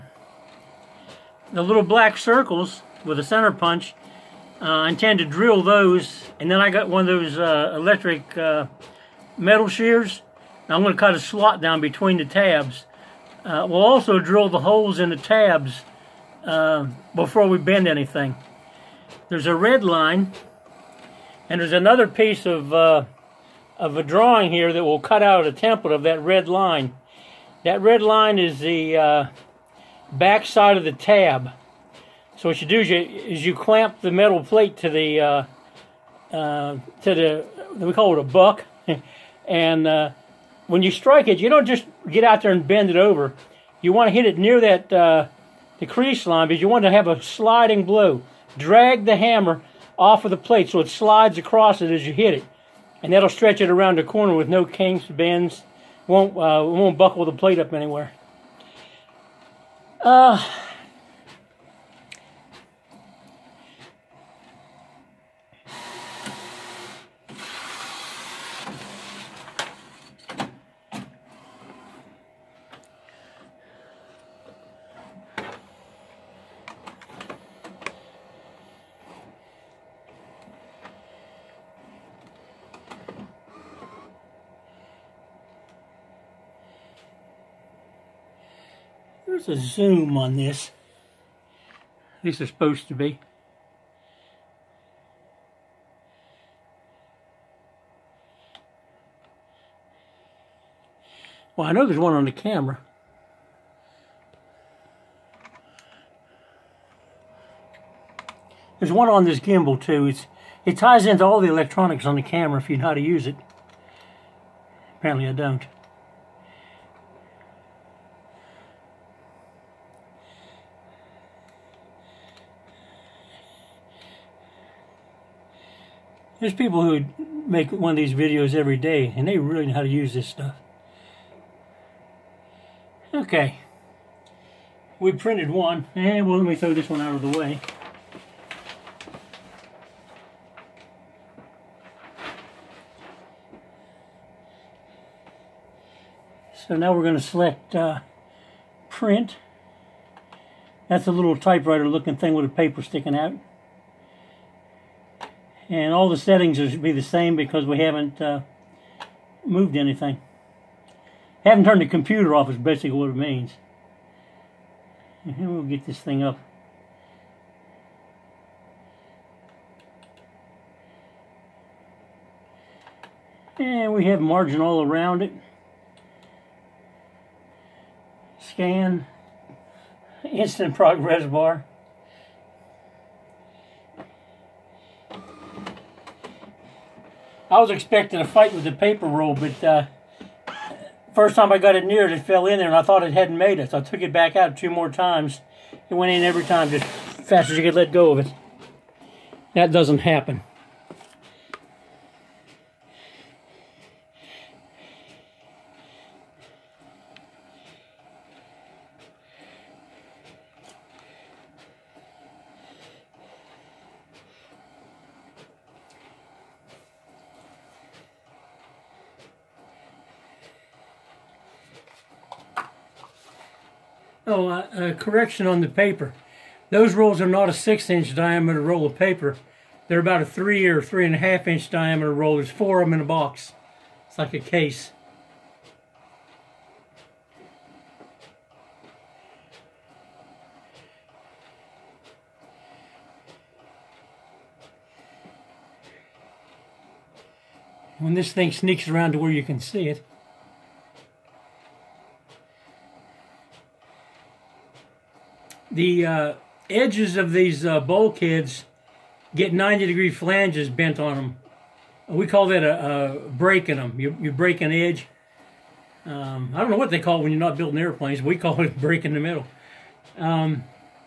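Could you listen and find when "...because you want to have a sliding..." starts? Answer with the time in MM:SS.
00:46.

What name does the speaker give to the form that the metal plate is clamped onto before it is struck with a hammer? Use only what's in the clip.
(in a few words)
buck.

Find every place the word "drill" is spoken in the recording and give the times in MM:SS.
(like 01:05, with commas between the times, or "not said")
00:05, 00:14.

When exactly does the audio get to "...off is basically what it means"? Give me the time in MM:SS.
02:42.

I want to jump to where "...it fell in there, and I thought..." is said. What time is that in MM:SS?
03:12.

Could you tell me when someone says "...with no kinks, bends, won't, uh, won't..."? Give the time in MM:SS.
00:54.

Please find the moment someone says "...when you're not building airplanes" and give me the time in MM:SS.
04:27.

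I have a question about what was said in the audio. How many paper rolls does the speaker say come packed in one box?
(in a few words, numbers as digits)
4.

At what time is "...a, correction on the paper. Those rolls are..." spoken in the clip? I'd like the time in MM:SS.
03:44.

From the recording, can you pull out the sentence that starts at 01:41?
Well, I know there's one on the camera.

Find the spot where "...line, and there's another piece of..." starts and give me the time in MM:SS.
00:19.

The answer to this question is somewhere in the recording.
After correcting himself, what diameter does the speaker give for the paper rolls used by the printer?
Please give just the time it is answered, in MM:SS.
03:50.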